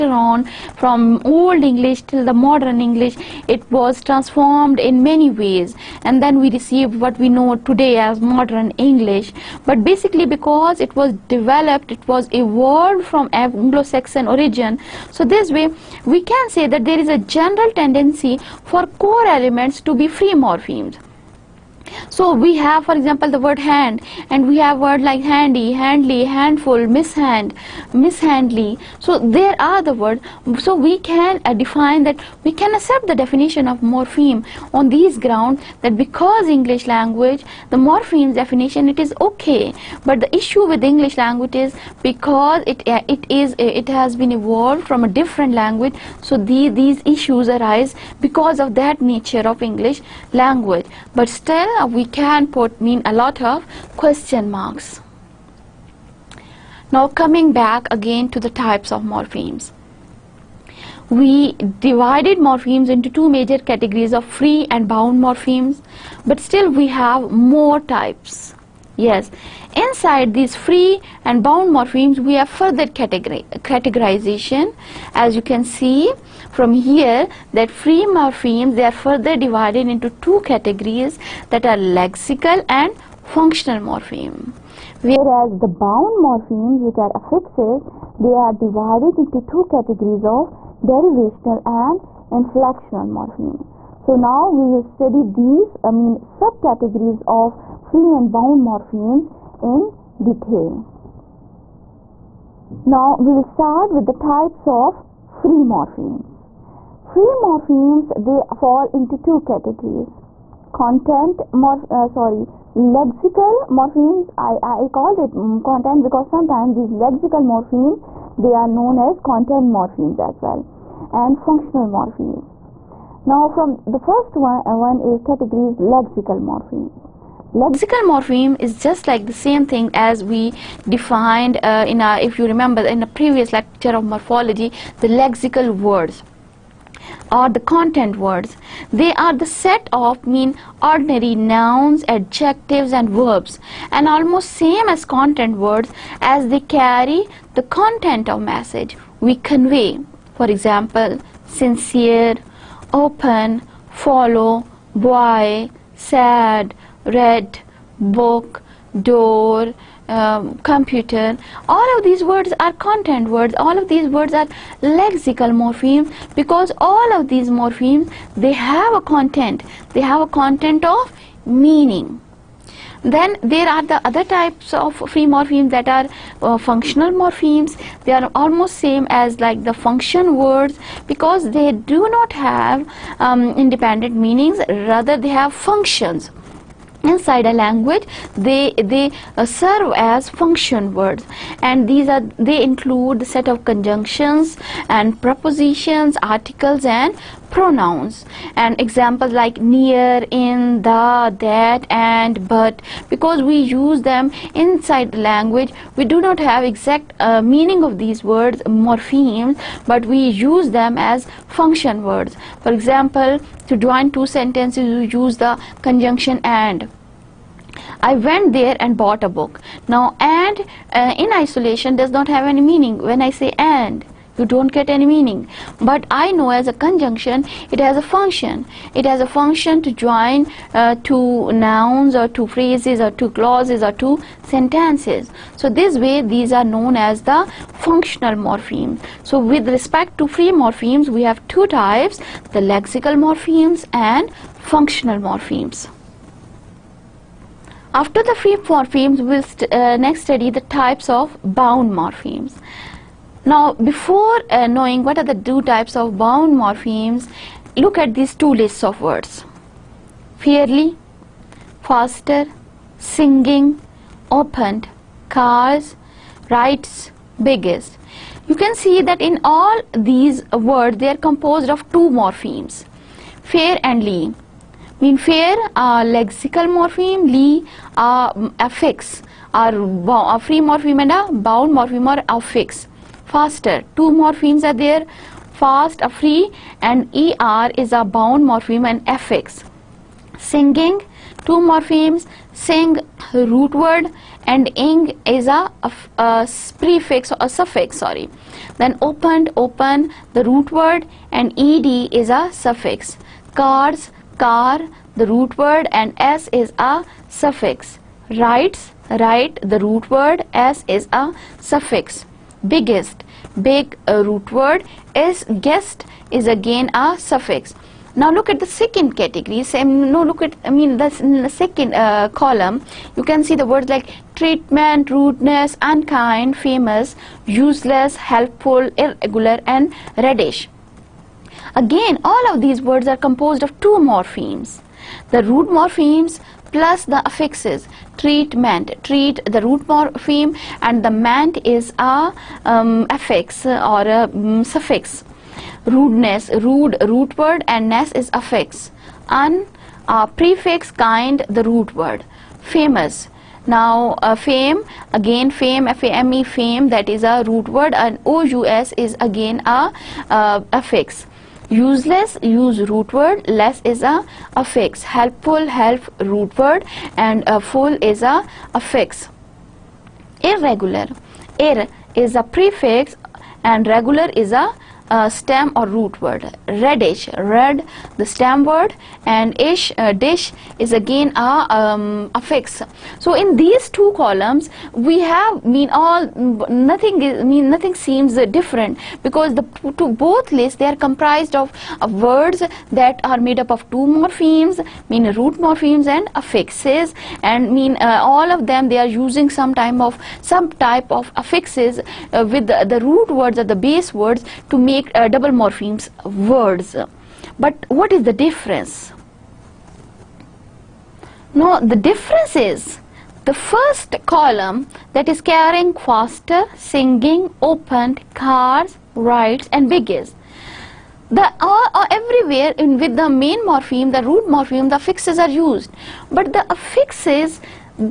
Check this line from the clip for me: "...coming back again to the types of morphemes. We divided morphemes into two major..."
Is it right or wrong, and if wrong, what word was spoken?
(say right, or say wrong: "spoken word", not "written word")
right.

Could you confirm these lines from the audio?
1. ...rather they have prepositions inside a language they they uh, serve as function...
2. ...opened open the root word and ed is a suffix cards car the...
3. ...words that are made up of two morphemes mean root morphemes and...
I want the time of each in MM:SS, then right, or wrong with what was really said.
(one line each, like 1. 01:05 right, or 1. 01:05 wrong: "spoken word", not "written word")
1. 03:04 wrong: "functions", not "prepositions"
2. 04:59 right
3. 06:32 right.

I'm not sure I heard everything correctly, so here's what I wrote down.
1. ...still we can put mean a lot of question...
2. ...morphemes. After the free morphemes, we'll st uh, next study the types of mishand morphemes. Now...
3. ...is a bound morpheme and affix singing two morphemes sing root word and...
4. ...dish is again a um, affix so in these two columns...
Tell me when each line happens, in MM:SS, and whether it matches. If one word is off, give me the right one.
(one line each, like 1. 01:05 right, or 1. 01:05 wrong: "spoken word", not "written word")
1. 00:51 right
2. 04:05 wrong: "bound", not "mishand"
3. 04:47 right
4. 06:20 right.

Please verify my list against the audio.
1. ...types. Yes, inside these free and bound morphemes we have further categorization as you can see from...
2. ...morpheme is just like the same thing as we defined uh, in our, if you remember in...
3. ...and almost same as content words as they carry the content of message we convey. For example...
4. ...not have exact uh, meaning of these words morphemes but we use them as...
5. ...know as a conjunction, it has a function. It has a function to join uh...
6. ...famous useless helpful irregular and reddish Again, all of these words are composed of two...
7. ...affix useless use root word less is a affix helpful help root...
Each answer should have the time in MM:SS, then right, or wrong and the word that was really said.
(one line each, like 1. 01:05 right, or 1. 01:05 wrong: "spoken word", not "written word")
1. 01:07 right
2. 02:08 right
3. 02:23 right
4. 03:26 right
5. 03:46 right
6. 05:26 right
7. 06:00 right.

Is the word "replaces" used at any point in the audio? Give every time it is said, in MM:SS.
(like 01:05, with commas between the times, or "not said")
not said.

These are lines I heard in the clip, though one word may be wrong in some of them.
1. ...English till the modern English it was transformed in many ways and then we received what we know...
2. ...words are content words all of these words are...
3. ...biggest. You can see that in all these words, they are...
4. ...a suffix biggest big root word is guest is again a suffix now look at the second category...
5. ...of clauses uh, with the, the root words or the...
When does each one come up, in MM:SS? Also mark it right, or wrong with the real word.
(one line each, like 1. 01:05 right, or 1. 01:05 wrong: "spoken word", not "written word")
1. 00:01 right
2. 02:42 right
3. 04:27 right
4. 05:11 right
5. 06:41 wrong: "affixes", not "clauses".